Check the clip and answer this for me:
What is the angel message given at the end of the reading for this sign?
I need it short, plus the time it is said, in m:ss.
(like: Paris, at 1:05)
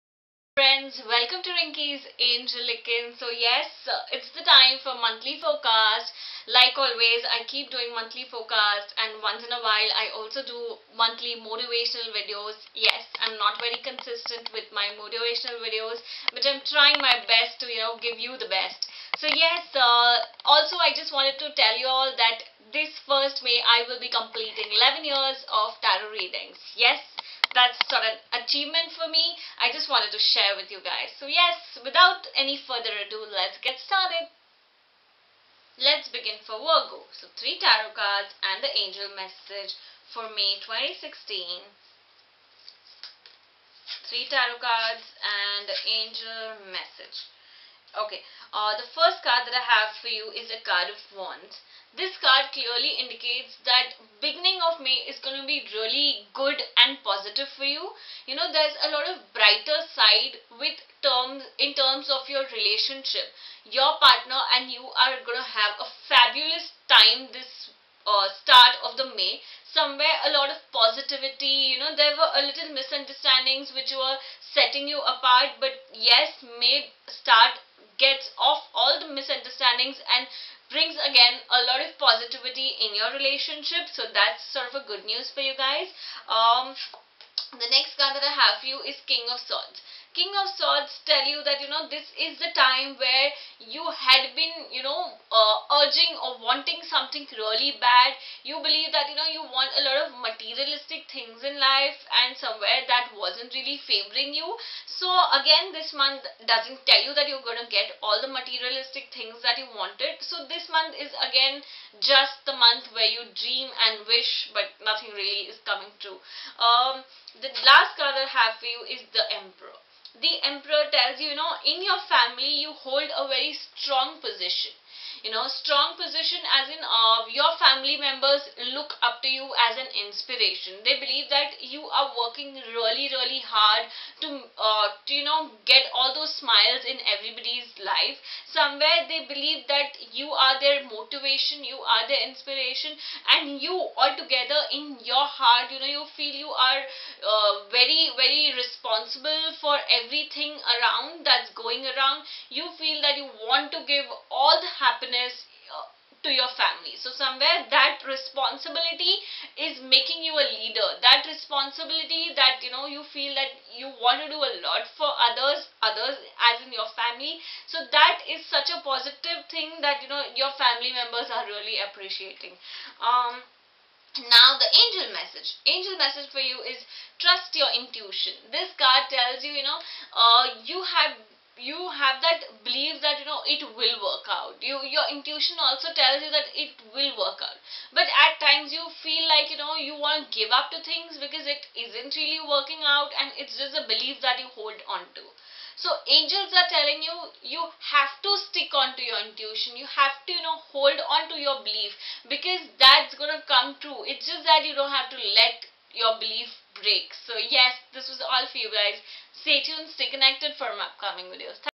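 Trust your intuition, at 2:57.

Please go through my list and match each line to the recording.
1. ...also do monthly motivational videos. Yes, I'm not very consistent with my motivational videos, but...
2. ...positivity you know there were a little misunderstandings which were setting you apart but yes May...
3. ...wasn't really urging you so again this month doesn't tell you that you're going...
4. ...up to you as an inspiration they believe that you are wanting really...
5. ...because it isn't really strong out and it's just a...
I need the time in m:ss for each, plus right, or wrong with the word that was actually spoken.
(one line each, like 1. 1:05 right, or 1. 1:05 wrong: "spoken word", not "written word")
1. 0:10 right
2. 1:10 right
3. 1:43 wrong: "favoring", not "urging"
4. 2:09 wrong: "working", not "wanting"
5. 3:11 wrong: "working", not "strong".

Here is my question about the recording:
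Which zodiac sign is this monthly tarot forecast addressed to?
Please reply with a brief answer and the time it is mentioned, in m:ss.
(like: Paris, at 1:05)
Virgo, at 0:36.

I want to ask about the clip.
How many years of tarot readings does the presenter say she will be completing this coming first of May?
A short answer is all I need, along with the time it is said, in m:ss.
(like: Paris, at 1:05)
11, at 0:25.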